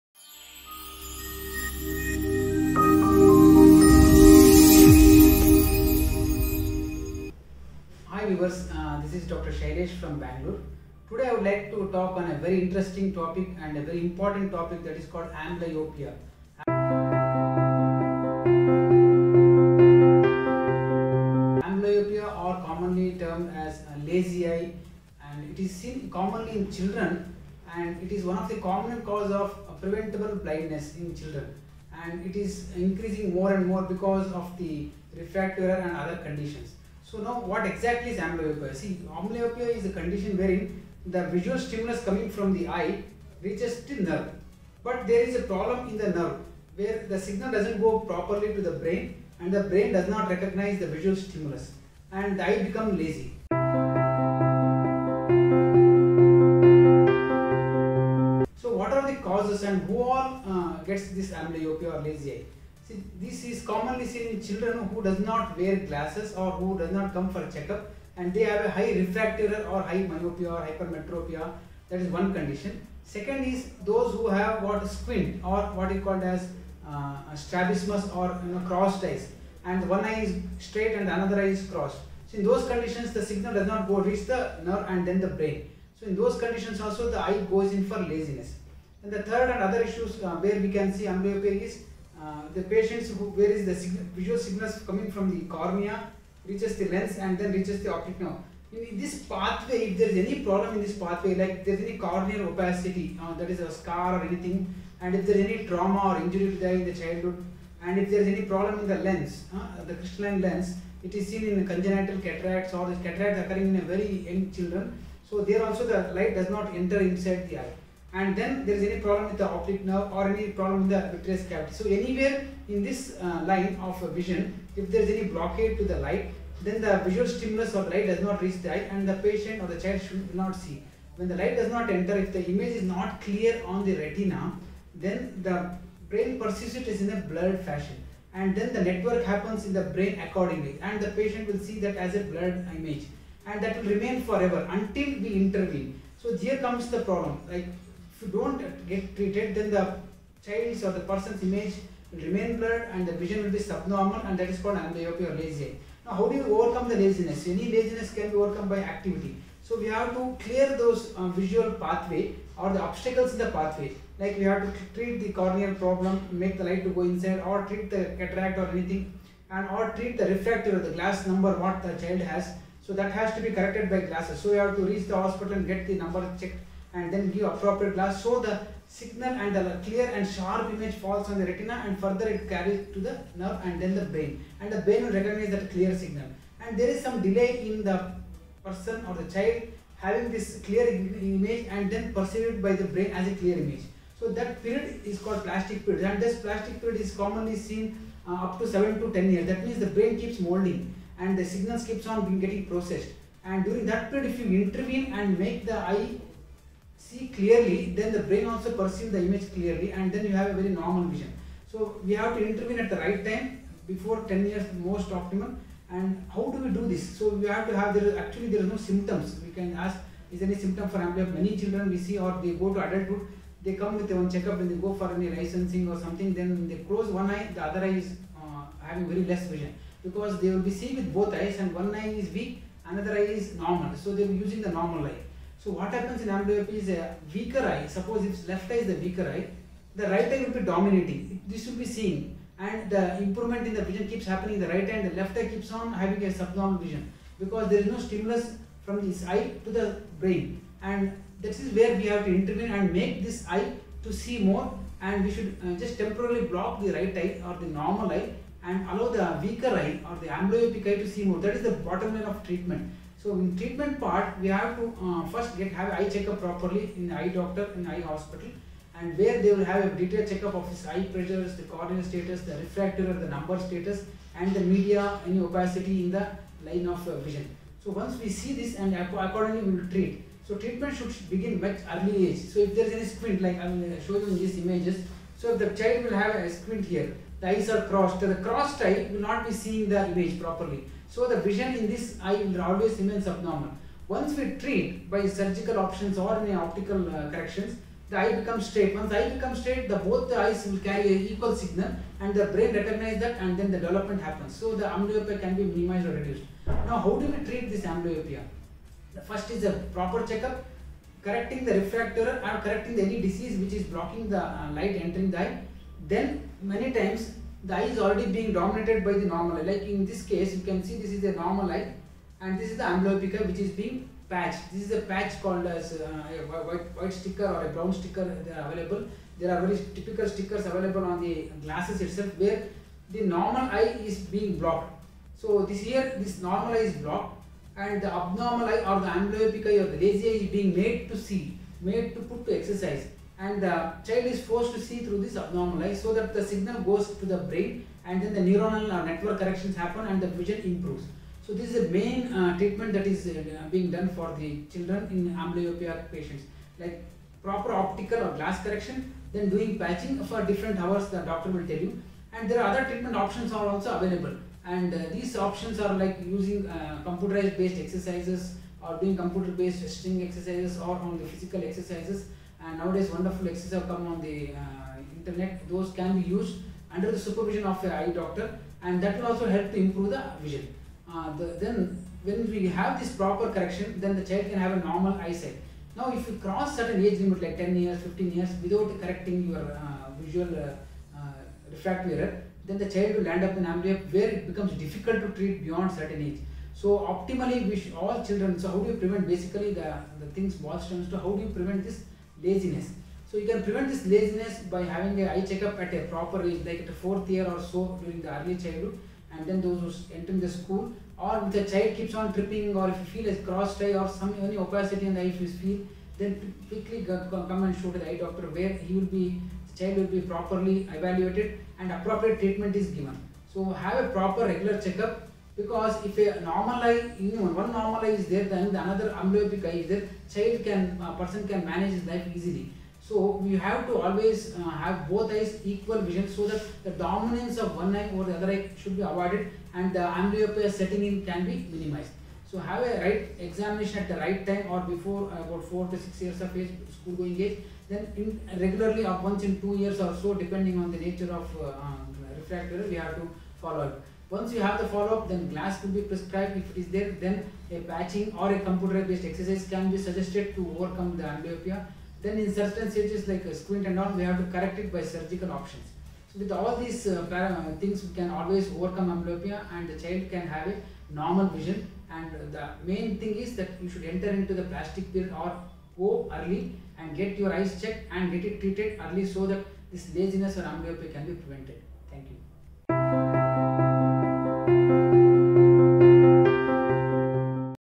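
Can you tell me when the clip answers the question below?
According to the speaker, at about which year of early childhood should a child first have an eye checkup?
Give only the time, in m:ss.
6:46.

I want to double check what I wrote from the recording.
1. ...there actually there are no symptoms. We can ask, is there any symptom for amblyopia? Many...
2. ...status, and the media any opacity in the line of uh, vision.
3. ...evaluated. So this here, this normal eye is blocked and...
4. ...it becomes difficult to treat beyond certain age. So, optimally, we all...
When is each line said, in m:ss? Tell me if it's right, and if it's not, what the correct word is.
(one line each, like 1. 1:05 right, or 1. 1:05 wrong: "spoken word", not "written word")
1. 3:37 right
2. 4:33 right
3. 5:34 wrong: "blocked", not "evaluated"
4. 6:34 right.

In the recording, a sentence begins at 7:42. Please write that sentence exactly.
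Then in certain stages like a squint and all, we have to correct it by surgical options.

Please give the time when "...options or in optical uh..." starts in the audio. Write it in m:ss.
4:55.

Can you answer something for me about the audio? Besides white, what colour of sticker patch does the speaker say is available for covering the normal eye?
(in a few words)
brown.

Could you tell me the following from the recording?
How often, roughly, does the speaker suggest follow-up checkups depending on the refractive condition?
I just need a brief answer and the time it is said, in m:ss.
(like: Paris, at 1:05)
once in 2 years, at 7:29.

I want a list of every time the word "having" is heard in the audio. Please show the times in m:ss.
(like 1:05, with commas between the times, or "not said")
3:10, 3:48, 4:05, 6:44.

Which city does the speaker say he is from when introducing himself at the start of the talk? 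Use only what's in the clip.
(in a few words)
Bangalore.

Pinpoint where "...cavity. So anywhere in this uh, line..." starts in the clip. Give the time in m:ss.
2:01.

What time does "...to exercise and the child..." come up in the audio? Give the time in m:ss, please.
5:42.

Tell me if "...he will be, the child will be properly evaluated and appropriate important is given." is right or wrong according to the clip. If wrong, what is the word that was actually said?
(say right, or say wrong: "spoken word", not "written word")
wrong: "treatment", not "important".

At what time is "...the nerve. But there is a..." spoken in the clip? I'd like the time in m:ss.
0:43.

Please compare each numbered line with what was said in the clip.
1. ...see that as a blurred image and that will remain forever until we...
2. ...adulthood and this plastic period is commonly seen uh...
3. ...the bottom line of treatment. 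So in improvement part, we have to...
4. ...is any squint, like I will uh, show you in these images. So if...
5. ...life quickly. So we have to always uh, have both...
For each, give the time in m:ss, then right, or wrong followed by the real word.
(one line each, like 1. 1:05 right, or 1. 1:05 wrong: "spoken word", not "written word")
1. 2:21 right
2. 3:15 wrong: "period", not "adulthood"
3. 4:21 wrong: "treatment", not "improvement"
4. 4:42 right
5. 7:12 wrong: "easily", not "quickly".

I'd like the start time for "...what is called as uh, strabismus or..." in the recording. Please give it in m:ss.
1:15.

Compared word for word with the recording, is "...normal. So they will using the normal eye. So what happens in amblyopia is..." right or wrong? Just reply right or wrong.
right.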